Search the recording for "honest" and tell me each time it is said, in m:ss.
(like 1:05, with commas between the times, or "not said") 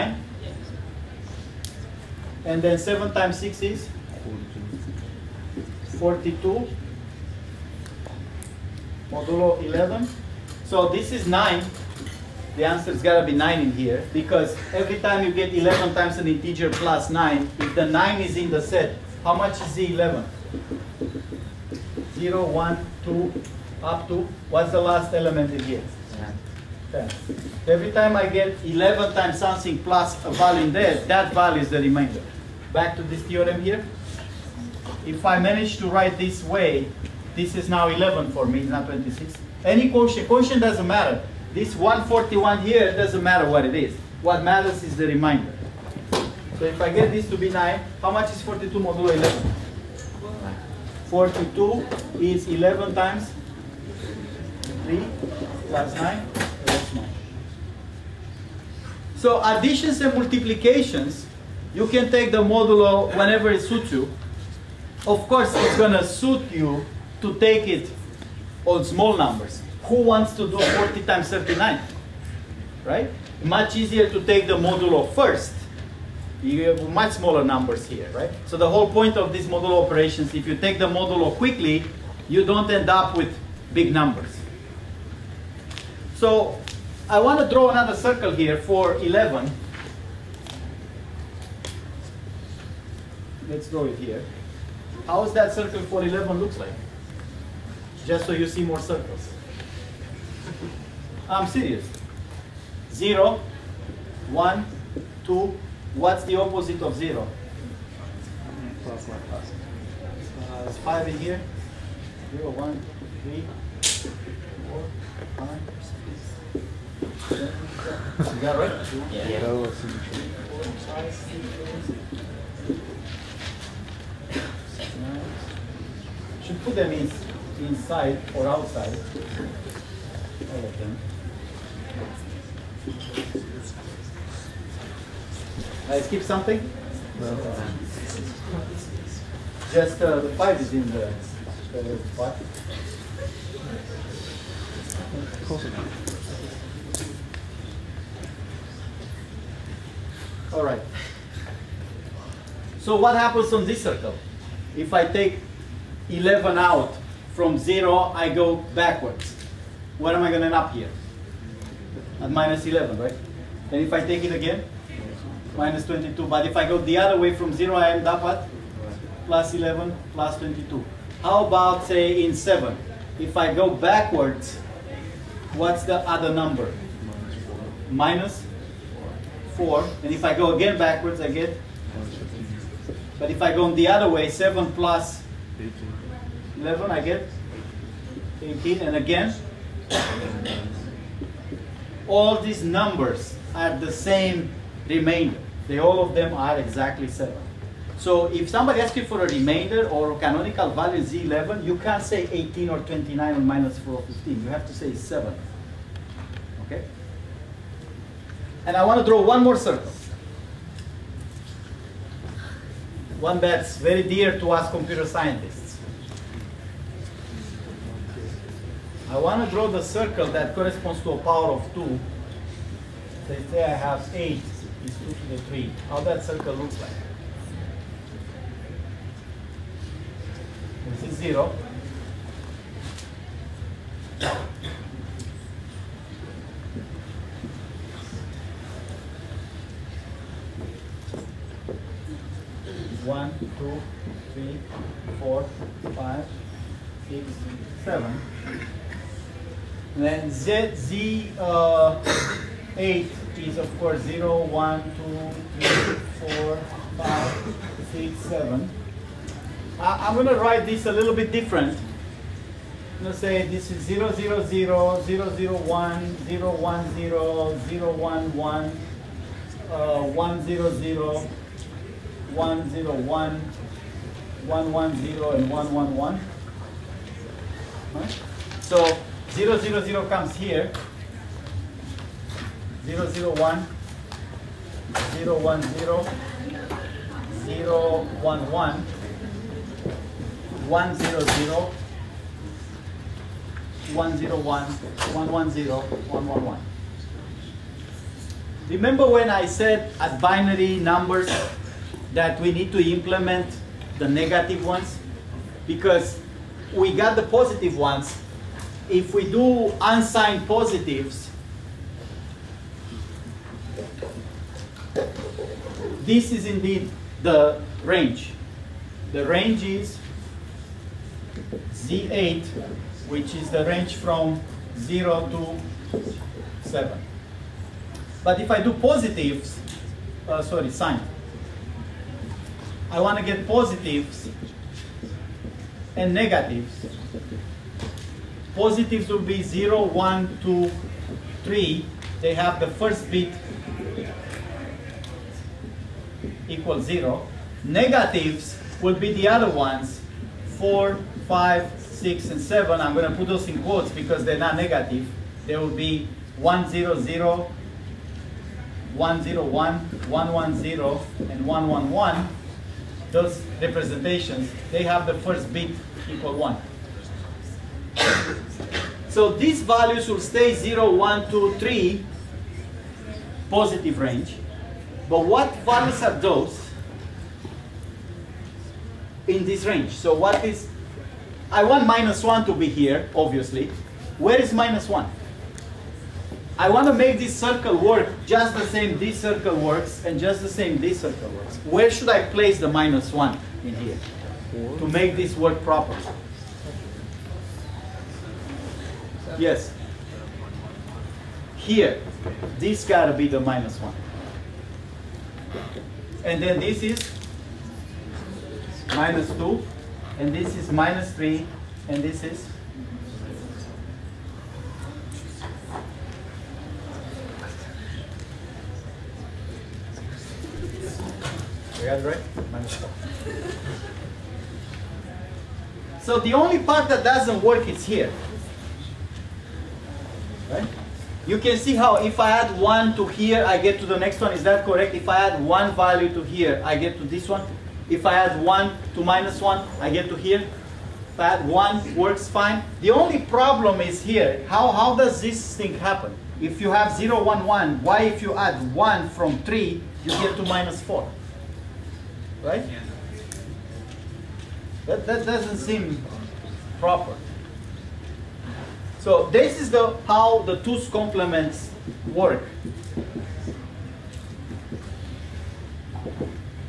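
not said.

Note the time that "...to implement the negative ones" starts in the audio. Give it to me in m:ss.
5:02.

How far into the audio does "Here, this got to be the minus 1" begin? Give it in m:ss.
6:41.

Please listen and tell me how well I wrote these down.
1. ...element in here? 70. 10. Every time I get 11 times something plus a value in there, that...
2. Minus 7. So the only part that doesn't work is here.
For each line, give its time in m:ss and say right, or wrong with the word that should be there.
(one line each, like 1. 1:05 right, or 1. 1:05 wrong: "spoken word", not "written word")
1. 0:25 wrong: "10", not "70"
2. 7:02 wrong: "4", not "7".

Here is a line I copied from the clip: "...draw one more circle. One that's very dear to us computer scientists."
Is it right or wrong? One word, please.
right.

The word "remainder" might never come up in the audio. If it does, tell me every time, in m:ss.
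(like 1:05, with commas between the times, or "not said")
0:31, 3:14, 3:19.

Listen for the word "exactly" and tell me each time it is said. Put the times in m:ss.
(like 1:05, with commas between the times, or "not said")
3:16.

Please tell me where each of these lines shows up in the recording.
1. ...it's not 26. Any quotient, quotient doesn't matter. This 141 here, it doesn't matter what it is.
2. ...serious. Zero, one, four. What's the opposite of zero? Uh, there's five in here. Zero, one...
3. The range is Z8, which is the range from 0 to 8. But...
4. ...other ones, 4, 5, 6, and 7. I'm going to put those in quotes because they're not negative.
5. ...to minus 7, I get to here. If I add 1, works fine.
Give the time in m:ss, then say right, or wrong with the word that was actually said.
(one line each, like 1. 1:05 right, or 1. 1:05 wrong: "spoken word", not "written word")
1. 0:38 right
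2. 1:41 wrong: "two", not "four"
3. 5:19 wrong: "7", not "8"
4. 5:49 right
5. 7:18 wrong: "1", not "7".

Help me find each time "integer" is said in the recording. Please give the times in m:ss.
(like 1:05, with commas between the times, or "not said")
0:16.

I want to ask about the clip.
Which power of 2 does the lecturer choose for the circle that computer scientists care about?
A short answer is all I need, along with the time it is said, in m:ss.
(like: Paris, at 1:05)
8, at 3:44.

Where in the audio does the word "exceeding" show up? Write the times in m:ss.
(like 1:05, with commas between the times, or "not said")
not said.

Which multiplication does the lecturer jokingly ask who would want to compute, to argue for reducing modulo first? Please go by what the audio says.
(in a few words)
40 times 39.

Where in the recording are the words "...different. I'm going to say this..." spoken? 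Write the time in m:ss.
4:21.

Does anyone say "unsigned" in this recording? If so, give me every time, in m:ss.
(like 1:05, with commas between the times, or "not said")
5:09.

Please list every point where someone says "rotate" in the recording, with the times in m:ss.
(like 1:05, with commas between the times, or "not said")
not said.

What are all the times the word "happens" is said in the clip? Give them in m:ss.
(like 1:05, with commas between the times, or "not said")
2:33, 7:25.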